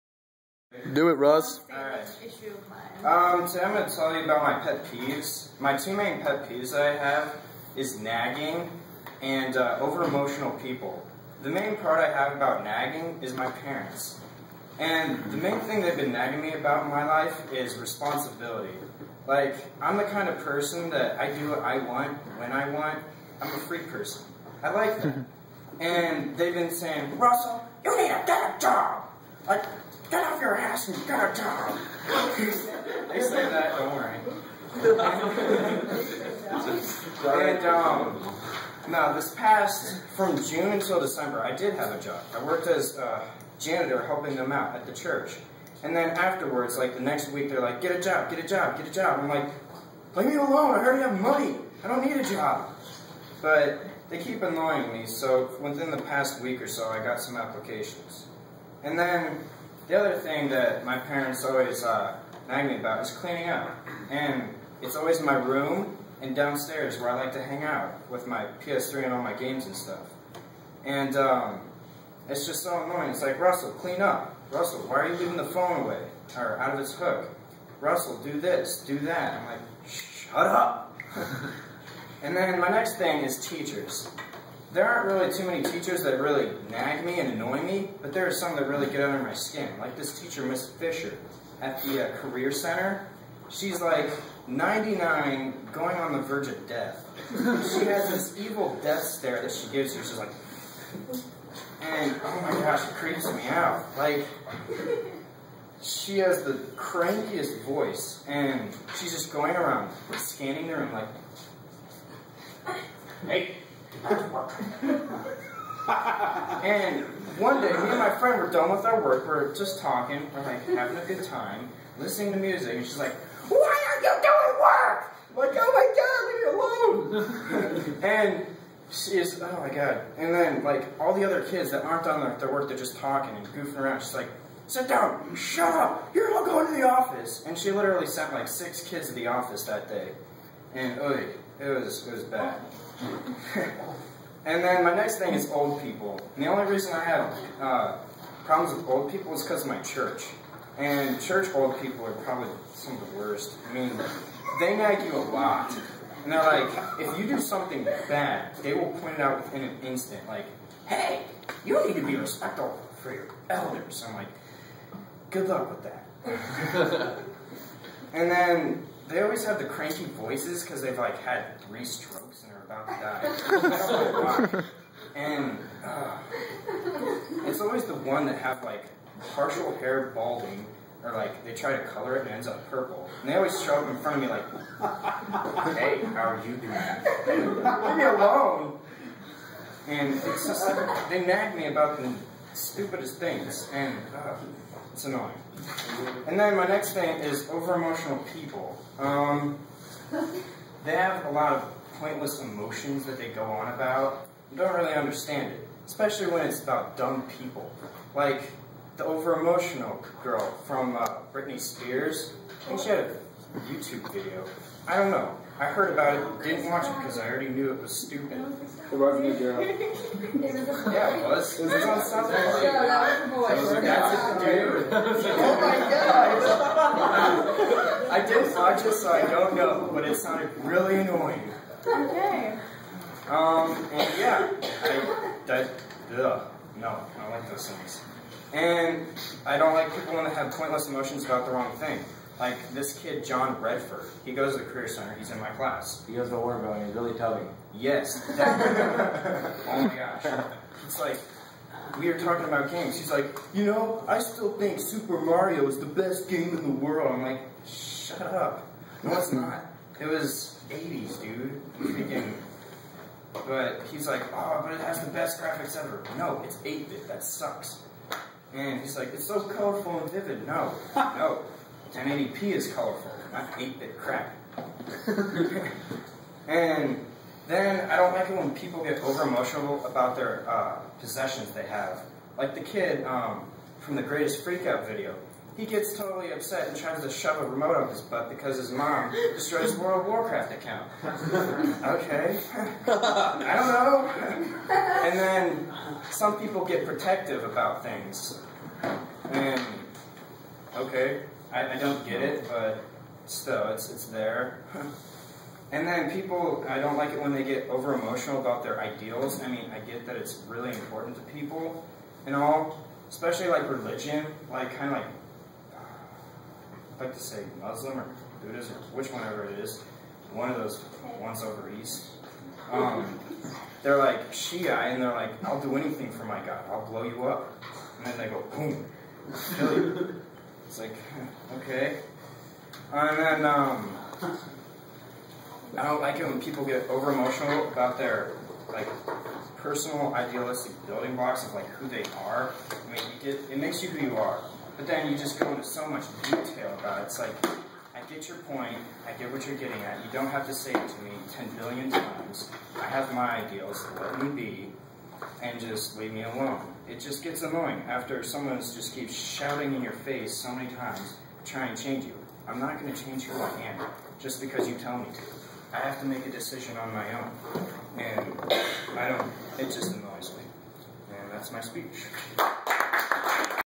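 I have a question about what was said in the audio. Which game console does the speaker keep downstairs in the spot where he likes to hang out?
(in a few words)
PS3.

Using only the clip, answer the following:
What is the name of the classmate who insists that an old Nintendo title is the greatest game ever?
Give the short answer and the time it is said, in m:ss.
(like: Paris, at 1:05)
John Redford, at 4:03.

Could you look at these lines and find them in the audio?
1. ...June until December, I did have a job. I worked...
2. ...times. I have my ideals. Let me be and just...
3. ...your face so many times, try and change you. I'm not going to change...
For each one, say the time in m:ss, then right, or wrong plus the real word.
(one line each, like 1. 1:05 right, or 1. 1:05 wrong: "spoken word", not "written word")
1. 0:40 right
2. 5:51 right
3. 5:59 right.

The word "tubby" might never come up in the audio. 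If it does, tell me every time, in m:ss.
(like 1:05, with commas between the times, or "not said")
4:07.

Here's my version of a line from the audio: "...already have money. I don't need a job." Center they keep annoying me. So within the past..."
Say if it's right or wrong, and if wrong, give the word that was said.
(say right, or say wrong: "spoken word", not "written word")
wrong: "But", not "Center".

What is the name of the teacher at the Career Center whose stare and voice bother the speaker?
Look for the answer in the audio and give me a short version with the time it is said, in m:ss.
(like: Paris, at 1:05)
Miss Fisher, at 1:30.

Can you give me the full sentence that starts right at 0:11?
The main part I have about nagging is my parents.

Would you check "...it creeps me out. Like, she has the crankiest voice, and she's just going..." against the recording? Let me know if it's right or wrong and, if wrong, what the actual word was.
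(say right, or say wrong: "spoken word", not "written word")
right.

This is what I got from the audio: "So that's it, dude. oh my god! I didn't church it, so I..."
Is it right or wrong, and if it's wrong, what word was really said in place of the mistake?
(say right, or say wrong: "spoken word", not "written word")
wrong: "watch", not "church".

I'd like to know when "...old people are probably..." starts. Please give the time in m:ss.
2:31.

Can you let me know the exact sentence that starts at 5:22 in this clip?
Um, they're like Shia and they're like, I'll do anything for my God, I'll blow you up.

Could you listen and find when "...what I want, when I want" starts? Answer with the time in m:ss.
0:21.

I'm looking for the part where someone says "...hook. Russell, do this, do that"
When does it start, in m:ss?
1:16.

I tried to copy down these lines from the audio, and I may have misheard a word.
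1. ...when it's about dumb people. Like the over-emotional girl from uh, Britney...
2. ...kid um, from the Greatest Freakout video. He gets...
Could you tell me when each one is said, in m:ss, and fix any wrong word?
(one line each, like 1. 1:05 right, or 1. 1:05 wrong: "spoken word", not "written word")
1. 3:26 right
2. 4:42 right.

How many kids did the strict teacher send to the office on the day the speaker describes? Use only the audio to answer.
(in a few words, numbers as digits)
6.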